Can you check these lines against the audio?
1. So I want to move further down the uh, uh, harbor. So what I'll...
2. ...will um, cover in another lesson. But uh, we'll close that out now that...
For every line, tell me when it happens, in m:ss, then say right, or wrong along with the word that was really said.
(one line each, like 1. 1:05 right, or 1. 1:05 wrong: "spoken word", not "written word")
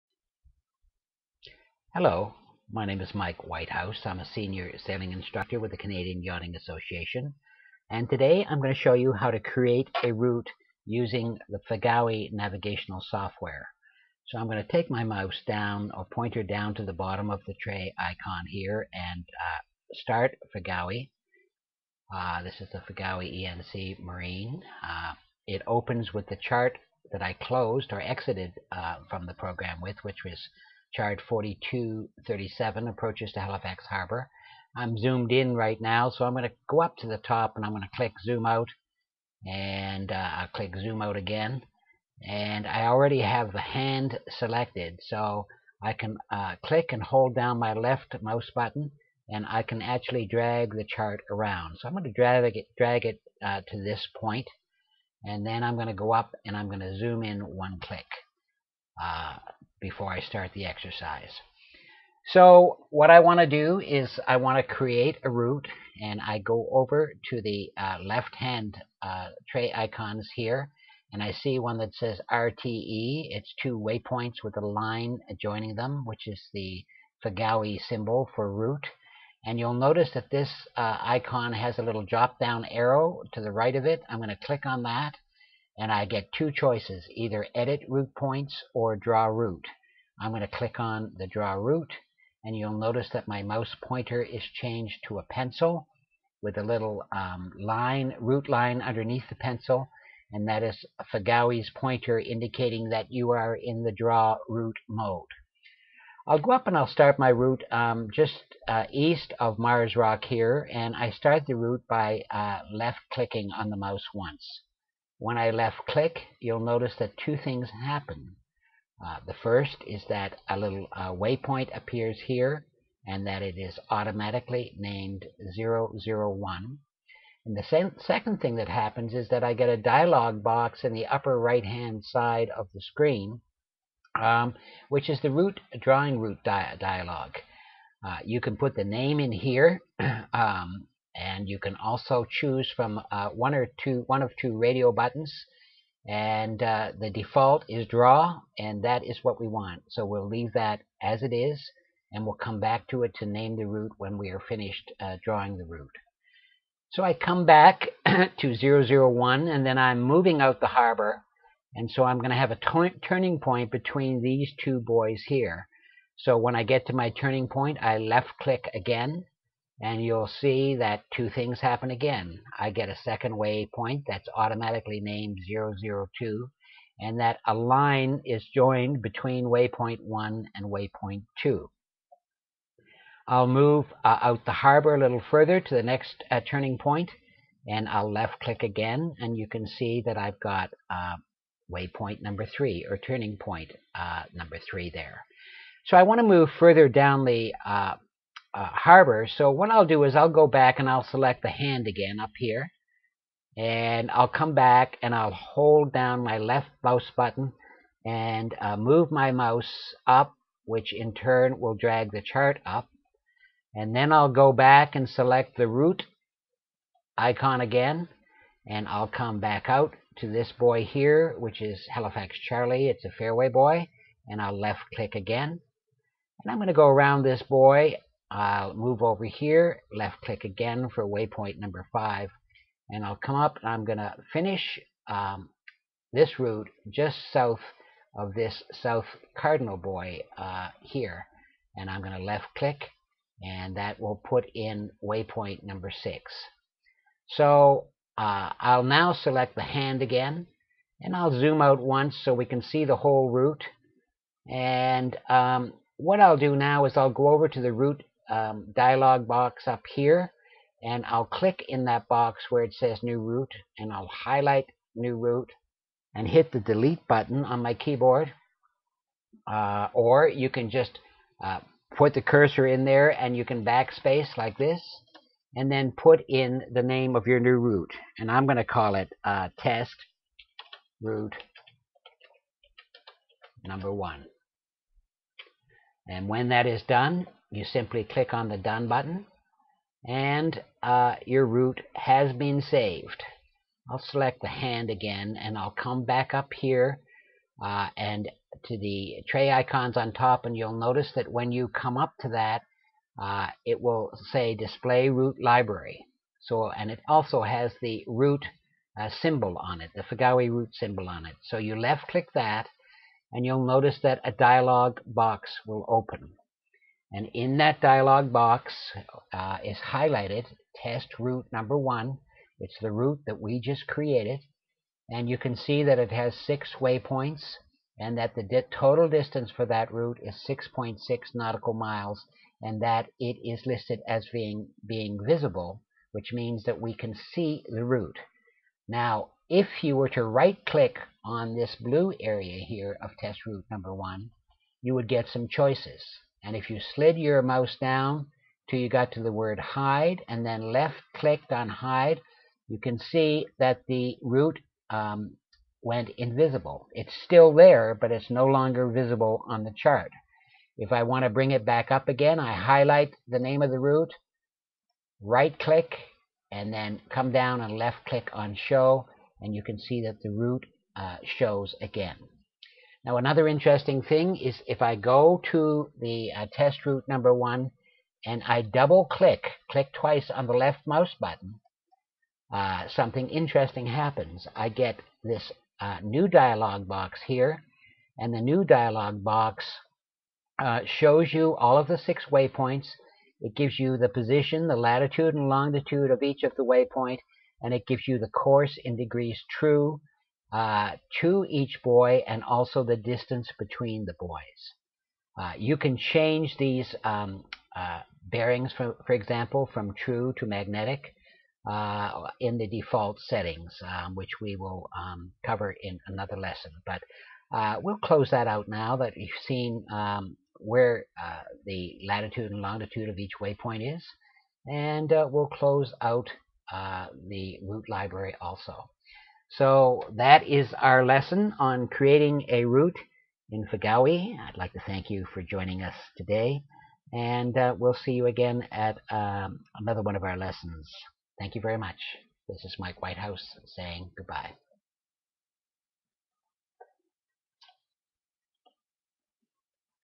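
1. 3:15 right
2. 6:54 right.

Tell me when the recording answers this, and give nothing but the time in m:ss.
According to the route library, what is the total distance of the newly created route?
5:30.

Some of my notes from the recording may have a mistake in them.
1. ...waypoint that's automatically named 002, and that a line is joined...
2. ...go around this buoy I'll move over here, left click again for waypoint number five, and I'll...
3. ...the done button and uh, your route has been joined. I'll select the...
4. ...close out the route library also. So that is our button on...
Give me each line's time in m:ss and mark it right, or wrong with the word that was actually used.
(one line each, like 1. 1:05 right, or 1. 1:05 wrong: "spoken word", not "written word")
1. 2:53 right
2. 3:46 right
3. 4:48 wrong: "saved", not "joined"
4. 7:05 wrong: "lesson", not "button".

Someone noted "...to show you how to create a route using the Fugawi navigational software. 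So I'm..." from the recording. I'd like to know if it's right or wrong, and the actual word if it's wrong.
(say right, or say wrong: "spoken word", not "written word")
right.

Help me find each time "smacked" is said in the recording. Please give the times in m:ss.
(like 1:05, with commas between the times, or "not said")
not said.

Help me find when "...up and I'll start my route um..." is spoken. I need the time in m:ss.
1:46.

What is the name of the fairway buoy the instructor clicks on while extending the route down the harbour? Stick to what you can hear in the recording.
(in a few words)
Halifax Charlie.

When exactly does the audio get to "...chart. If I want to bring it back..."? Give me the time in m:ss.
5:59.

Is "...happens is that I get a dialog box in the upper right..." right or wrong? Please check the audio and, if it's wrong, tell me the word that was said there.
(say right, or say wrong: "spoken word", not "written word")
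right.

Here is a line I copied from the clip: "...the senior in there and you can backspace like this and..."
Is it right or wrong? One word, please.
wrong.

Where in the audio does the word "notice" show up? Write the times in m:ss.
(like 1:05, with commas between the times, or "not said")
1:19, 1:32, 1:56, 5:00, 5:13.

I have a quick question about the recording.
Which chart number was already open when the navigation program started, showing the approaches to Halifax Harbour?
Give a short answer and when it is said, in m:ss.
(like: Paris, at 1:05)
4237, at 0:31.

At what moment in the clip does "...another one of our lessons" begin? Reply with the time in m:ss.
7:19.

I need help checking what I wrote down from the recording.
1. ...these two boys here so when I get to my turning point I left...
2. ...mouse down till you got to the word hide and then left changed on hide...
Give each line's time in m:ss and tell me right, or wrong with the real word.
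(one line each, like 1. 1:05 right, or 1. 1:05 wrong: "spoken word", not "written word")
1. 2:44 right
2. 5:47 wrong: "clicked", not "changed".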